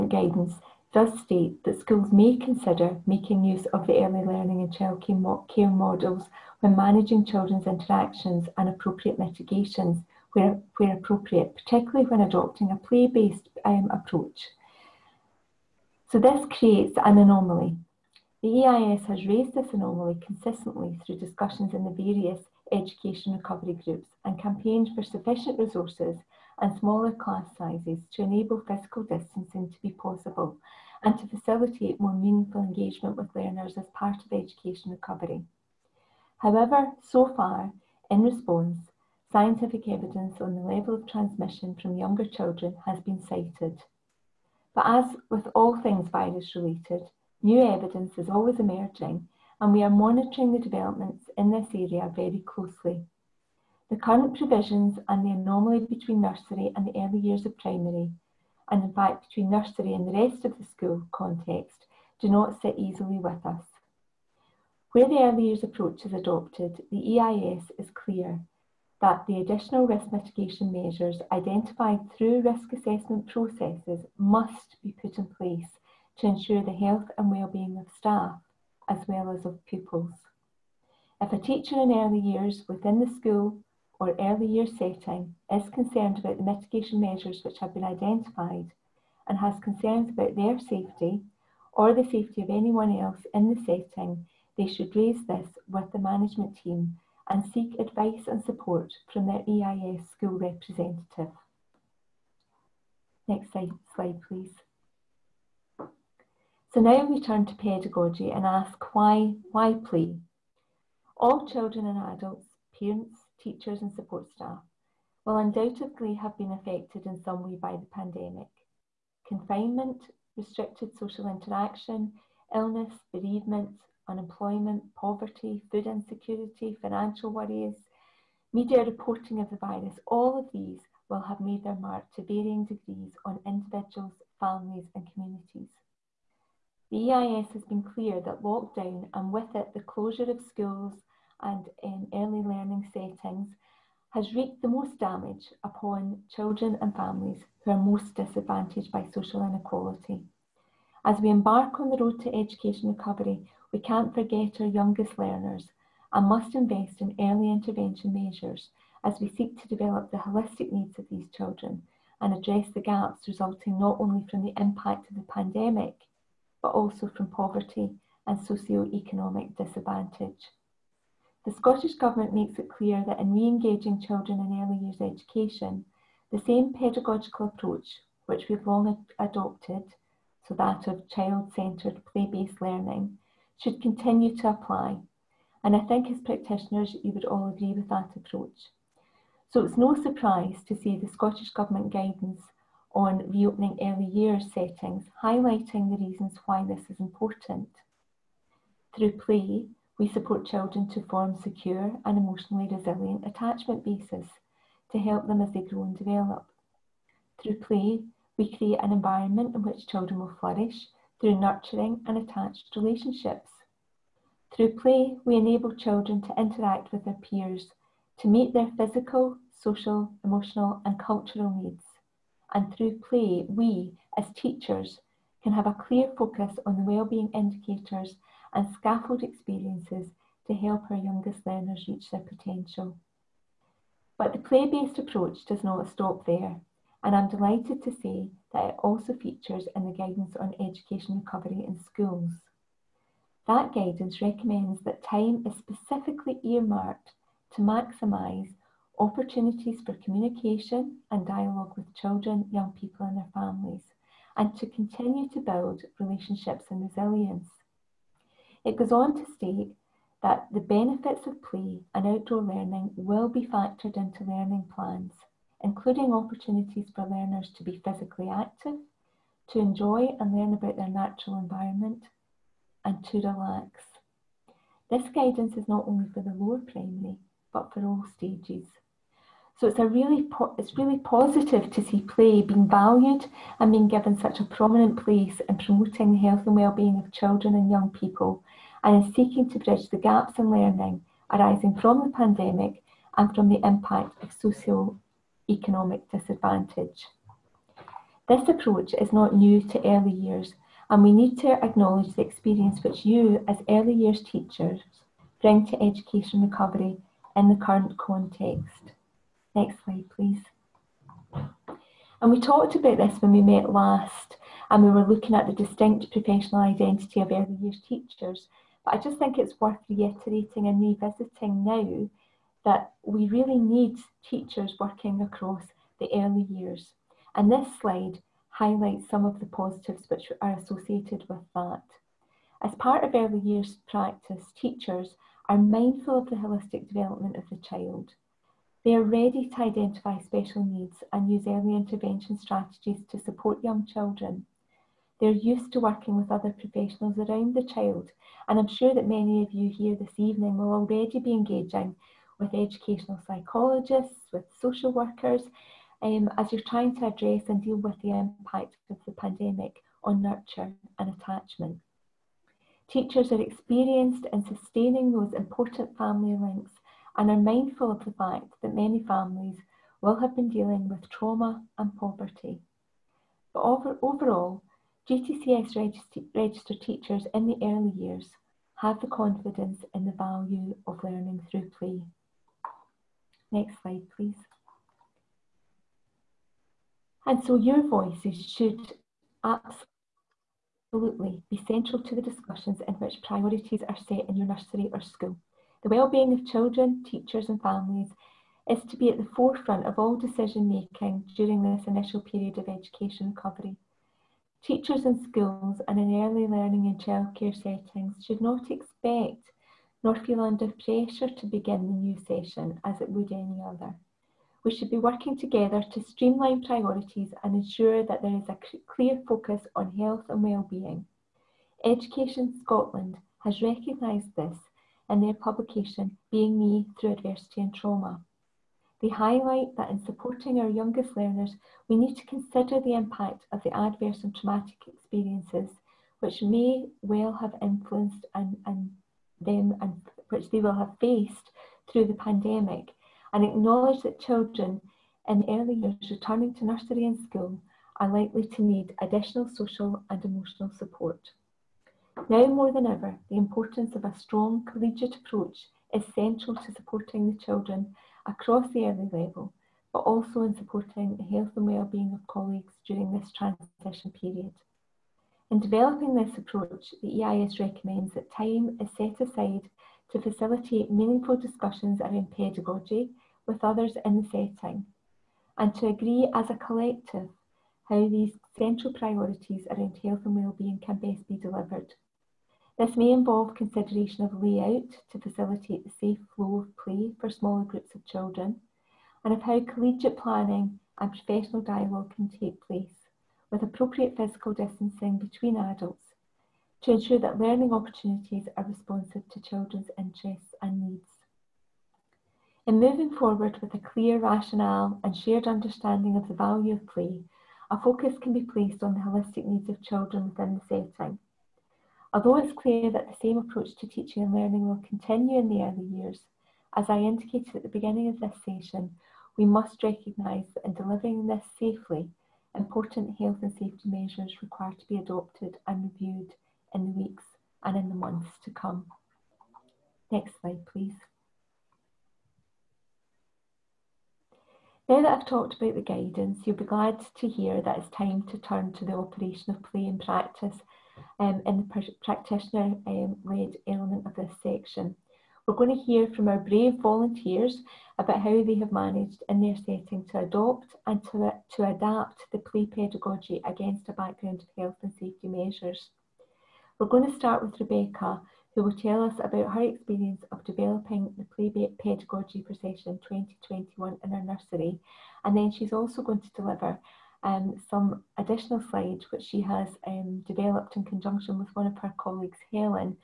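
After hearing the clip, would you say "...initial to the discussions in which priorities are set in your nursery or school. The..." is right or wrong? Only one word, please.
wrong.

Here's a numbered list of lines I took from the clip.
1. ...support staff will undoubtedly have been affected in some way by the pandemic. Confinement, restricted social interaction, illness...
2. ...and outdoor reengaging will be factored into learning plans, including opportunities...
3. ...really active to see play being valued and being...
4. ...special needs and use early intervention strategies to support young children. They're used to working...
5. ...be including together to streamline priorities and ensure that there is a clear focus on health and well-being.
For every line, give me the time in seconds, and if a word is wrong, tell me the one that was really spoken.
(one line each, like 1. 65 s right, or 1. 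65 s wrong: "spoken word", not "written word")
1. 113 s right
2. 261 s wrong: "learning", not "reengaging"
3. 280 s wrong: "positive", not "active"
4. 340 s right
5. 414 s wrong: "working", not "including".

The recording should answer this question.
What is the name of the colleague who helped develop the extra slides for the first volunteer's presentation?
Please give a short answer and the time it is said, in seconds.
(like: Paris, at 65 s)
Helen, at 572 s.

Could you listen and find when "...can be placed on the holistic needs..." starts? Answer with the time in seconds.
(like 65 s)
508 s.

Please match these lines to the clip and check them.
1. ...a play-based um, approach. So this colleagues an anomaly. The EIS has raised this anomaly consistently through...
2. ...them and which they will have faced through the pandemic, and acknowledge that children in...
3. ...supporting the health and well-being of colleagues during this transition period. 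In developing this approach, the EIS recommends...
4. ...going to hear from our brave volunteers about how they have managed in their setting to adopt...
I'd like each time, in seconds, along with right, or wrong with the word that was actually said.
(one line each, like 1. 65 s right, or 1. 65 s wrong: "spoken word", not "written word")
1. 12 s wrong: "creates", not "colleagues"
2. 439 s right
3. 460 s right
4. 545 s right.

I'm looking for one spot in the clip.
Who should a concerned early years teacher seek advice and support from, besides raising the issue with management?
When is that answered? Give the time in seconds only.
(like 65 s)
99 s.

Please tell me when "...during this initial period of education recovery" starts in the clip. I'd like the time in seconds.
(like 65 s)
401 s.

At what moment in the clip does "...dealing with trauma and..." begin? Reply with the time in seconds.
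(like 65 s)
370 s.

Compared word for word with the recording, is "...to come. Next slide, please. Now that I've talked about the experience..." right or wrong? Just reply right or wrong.
wrong.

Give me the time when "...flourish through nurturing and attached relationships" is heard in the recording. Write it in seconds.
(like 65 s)
210 s.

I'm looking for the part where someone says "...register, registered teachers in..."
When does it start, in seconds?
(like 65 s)
375 s.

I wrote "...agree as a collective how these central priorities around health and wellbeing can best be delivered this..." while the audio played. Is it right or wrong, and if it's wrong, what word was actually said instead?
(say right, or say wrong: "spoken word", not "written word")
right.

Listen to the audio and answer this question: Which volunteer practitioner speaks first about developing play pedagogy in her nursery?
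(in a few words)
Rebecca.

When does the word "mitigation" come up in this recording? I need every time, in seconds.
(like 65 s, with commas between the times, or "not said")
9 s, 70 s, 86 s.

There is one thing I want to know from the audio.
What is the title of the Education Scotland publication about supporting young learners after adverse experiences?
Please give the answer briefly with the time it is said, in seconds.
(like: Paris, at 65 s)
Being Me Through Adversity and Trauma, at 426 s.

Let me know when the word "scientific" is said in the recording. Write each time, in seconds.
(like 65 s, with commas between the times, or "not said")
39 s.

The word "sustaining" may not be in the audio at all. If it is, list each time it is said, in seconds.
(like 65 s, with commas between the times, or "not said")
364 s.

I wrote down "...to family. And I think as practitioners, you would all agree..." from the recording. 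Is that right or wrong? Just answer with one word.
wrong.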